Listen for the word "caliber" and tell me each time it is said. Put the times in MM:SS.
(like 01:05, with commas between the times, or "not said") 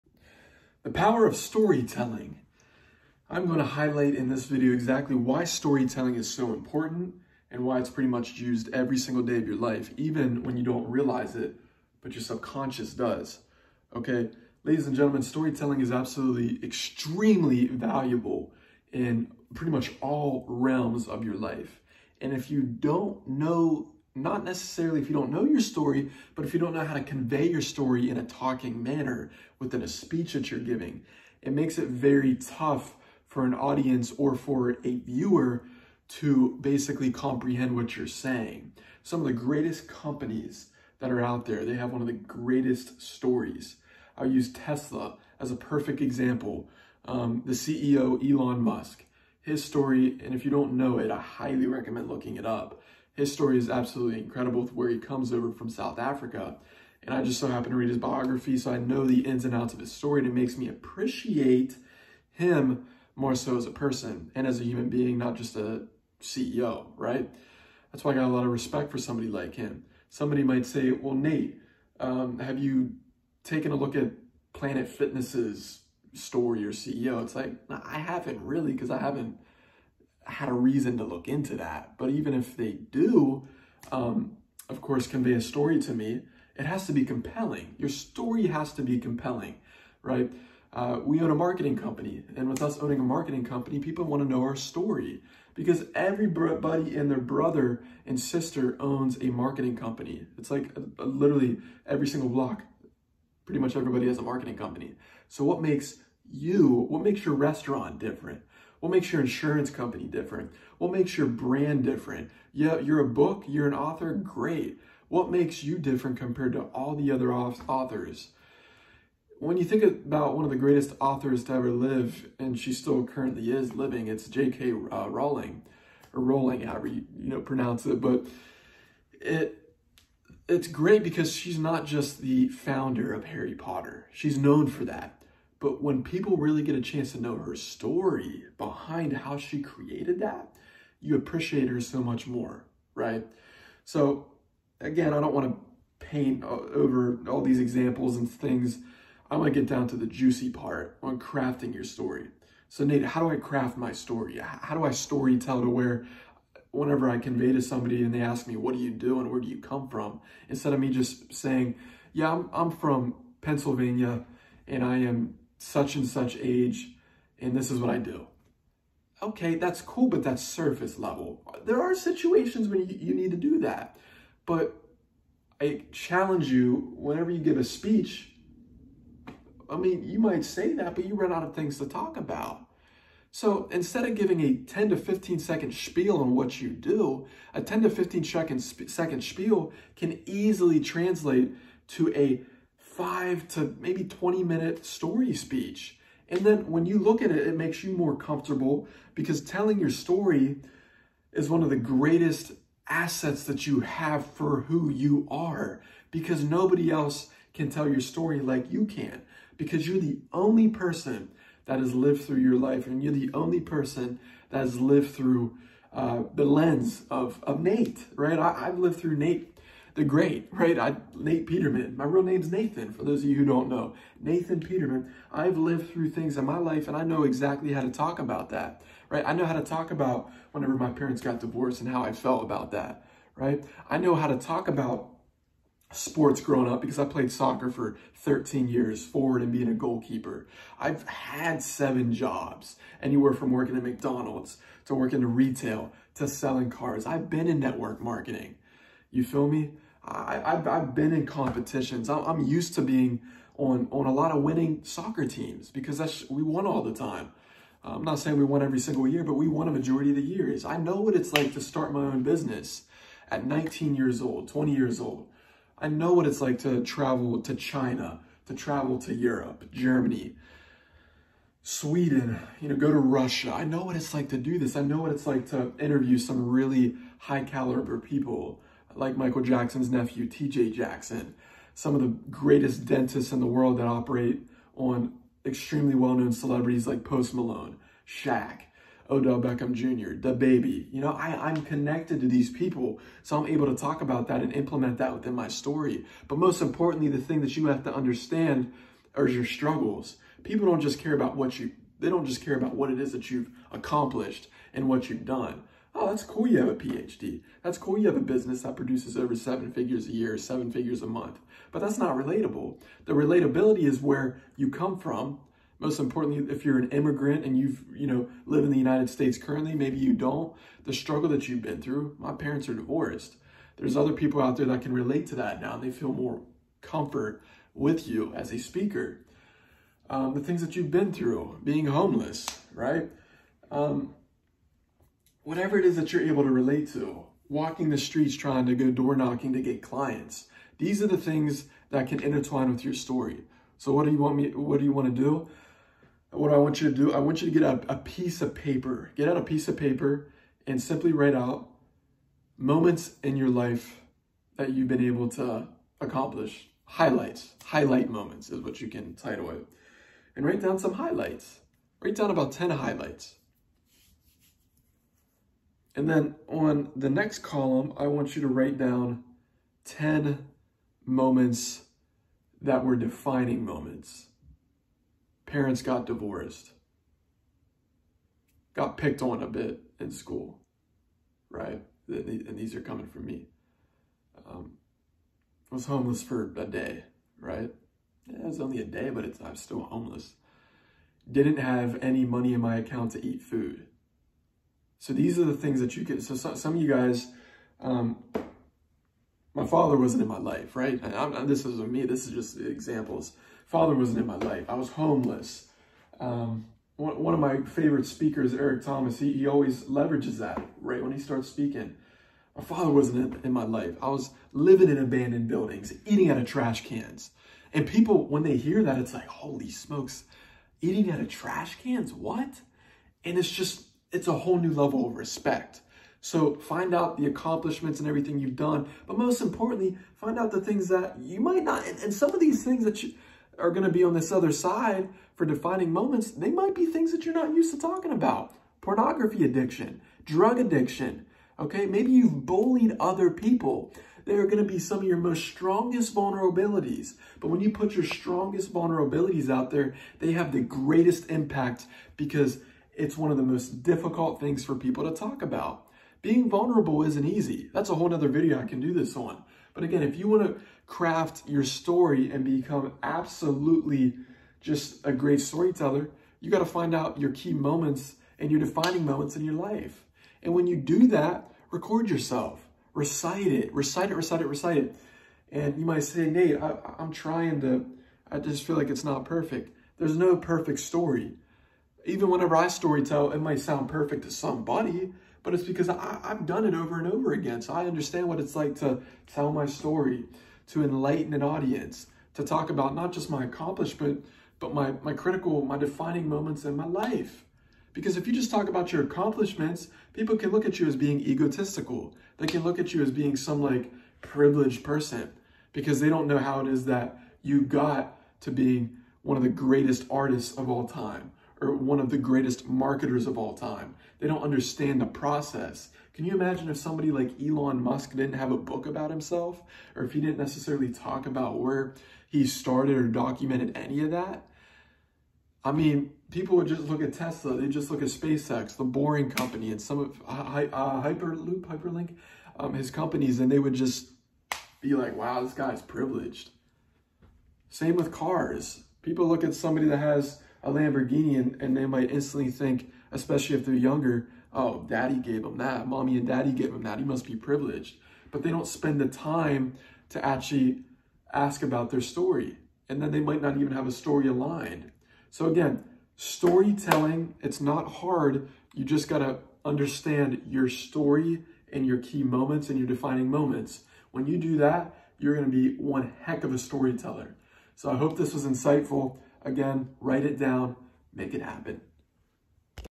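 04:37.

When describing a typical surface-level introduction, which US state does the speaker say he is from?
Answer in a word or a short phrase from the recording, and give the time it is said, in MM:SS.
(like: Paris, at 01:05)
Pennsylvania, at 02:43.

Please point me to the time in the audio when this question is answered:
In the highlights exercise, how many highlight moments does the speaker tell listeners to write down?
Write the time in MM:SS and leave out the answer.
06:02.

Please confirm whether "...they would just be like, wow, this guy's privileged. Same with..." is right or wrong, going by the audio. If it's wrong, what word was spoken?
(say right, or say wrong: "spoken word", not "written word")
right.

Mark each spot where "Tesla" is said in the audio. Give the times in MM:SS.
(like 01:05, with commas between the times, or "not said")
00:44, 08:47.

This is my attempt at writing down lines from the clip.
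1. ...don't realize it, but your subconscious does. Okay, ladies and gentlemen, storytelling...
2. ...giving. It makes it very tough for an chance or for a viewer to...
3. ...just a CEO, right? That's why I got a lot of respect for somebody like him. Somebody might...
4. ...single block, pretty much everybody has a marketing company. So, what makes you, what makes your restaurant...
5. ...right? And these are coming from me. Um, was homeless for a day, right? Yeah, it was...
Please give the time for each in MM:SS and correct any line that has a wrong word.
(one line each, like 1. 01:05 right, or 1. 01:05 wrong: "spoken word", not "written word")
1. 00:10 right
2. 00:30 wrong: "audience", not "chance"
3. 01:05 right
4. 01:42 right
5. 06:21 right.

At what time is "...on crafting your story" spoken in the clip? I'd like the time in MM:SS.
02:31.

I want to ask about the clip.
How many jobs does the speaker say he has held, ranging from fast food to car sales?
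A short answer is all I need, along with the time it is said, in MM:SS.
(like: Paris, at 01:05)
7, at 04:01.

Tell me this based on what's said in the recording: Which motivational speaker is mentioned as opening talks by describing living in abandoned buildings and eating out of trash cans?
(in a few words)
Eric Thomas.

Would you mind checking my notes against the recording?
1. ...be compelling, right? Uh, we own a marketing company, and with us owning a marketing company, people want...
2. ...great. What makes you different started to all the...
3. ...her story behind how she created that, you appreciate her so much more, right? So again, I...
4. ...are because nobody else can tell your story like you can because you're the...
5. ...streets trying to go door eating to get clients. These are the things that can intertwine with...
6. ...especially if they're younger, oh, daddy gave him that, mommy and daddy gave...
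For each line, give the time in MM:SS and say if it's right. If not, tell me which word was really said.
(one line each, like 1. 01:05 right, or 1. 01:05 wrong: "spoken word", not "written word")
1. 01:28 right
2. 01:54 wrong: "compared", not "started"
3. 02:17 right
4. 03:25 right
5. 05:37 wrong: "knocking", not "eating"
6. 09:03 right.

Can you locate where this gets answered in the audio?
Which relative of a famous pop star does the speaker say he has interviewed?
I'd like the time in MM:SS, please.
04:40.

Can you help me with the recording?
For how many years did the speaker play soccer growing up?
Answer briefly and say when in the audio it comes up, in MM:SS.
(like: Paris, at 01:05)
13, at 03:58.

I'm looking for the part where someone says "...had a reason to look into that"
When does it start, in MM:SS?
01:20.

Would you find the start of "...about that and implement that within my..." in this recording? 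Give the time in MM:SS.
04:54.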